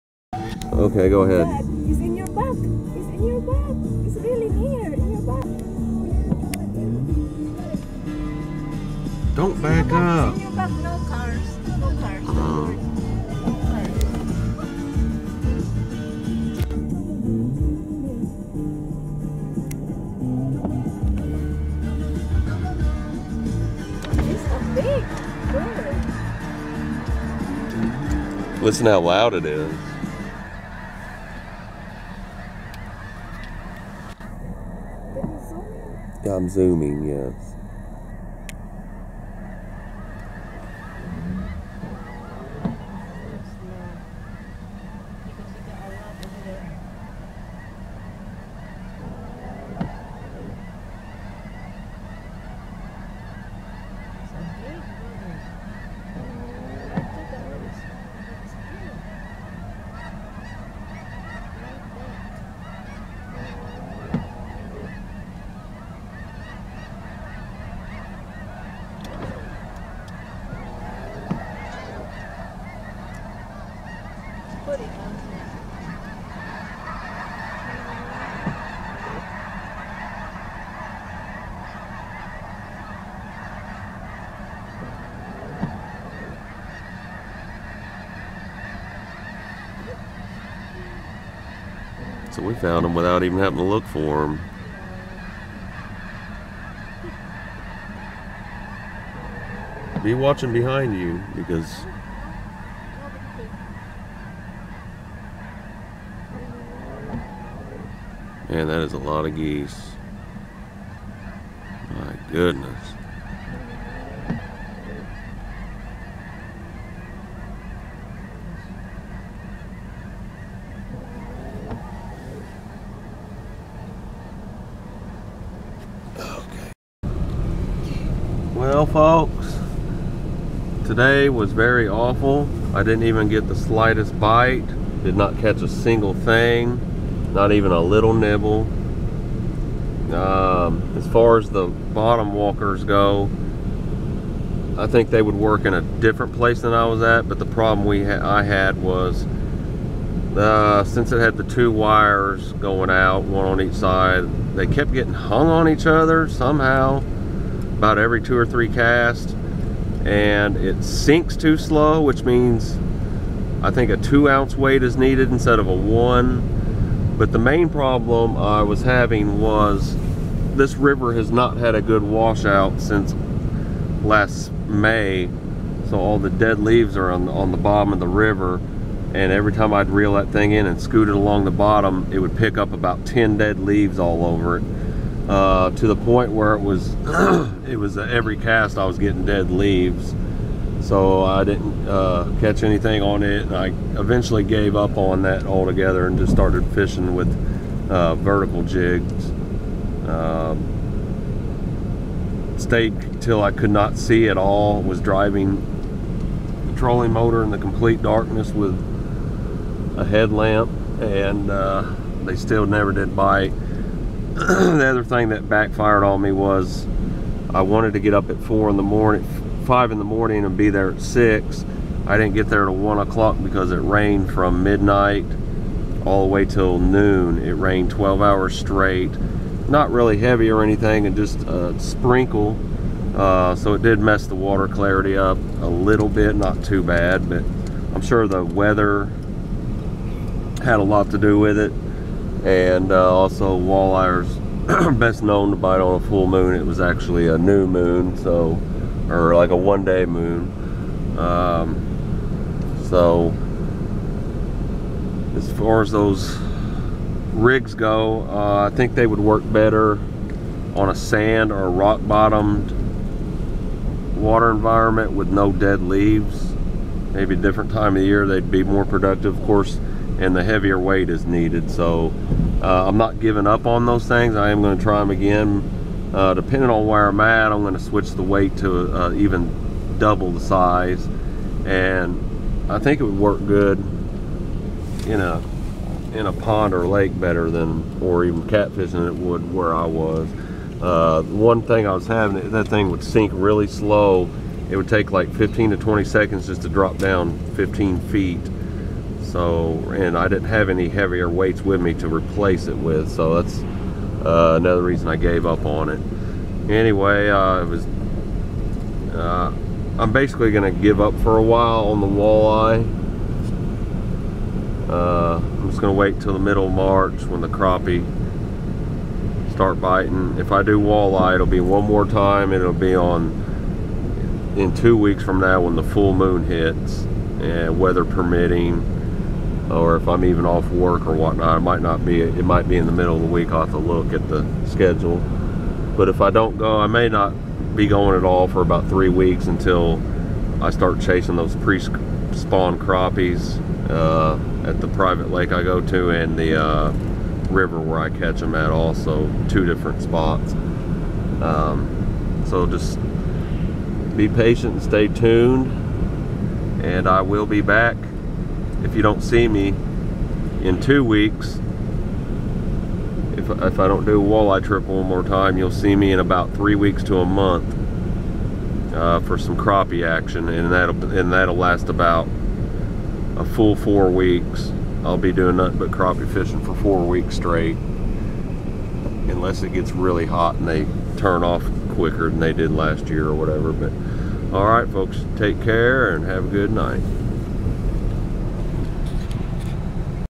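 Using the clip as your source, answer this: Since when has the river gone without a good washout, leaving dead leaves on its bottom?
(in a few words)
last May.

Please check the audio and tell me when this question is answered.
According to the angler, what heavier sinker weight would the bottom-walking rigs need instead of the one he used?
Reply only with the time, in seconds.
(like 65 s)
163 s.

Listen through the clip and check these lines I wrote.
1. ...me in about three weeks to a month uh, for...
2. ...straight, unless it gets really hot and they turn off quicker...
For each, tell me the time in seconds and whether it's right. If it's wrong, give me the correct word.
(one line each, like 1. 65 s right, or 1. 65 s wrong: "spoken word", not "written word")
1. 365 s right
2. 377 s right.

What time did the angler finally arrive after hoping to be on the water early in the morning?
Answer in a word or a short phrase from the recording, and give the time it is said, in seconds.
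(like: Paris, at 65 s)
one o'clock, at 222 s.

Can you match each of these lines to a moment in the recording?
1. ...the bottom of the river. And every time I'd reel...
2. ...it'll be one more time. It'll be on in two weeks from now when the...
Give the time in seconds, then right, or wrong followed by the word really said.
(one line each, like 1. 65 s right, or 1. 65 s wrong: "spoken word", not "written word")
1. 177 s right
2. 321 s right.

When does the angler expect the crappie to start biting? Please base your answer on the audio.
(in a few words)
middle of March.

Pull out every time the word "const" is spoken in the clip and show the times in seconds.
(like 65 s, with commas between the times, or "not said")
not said.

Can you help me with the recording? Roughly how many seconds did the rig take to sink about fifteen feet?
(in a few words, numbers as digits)
15 to 20 seconds.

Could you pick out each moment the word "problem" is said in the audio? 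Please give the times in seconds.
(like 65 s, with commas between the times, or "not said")
147 s, 167 s.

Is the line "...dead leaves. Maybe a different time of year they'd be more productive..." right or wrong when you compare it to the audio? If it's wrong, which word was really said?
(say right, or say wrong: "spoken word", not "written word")
right.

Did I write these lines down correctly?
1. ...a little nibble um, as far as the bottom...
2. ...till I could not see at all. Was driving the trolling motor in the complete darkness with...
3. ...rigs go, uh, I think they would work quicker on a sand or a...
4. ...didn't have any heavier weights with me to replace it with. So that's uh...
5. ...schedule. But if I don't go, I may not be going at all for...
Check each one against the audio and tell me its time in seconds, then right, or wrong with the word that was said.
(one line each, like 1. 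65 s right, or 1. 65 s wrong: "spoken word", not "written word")
1. 137 s right
2. 203 s right
3. 257 s wrong: "better", not "quicker"
4. 300 s right
5. 334 s right.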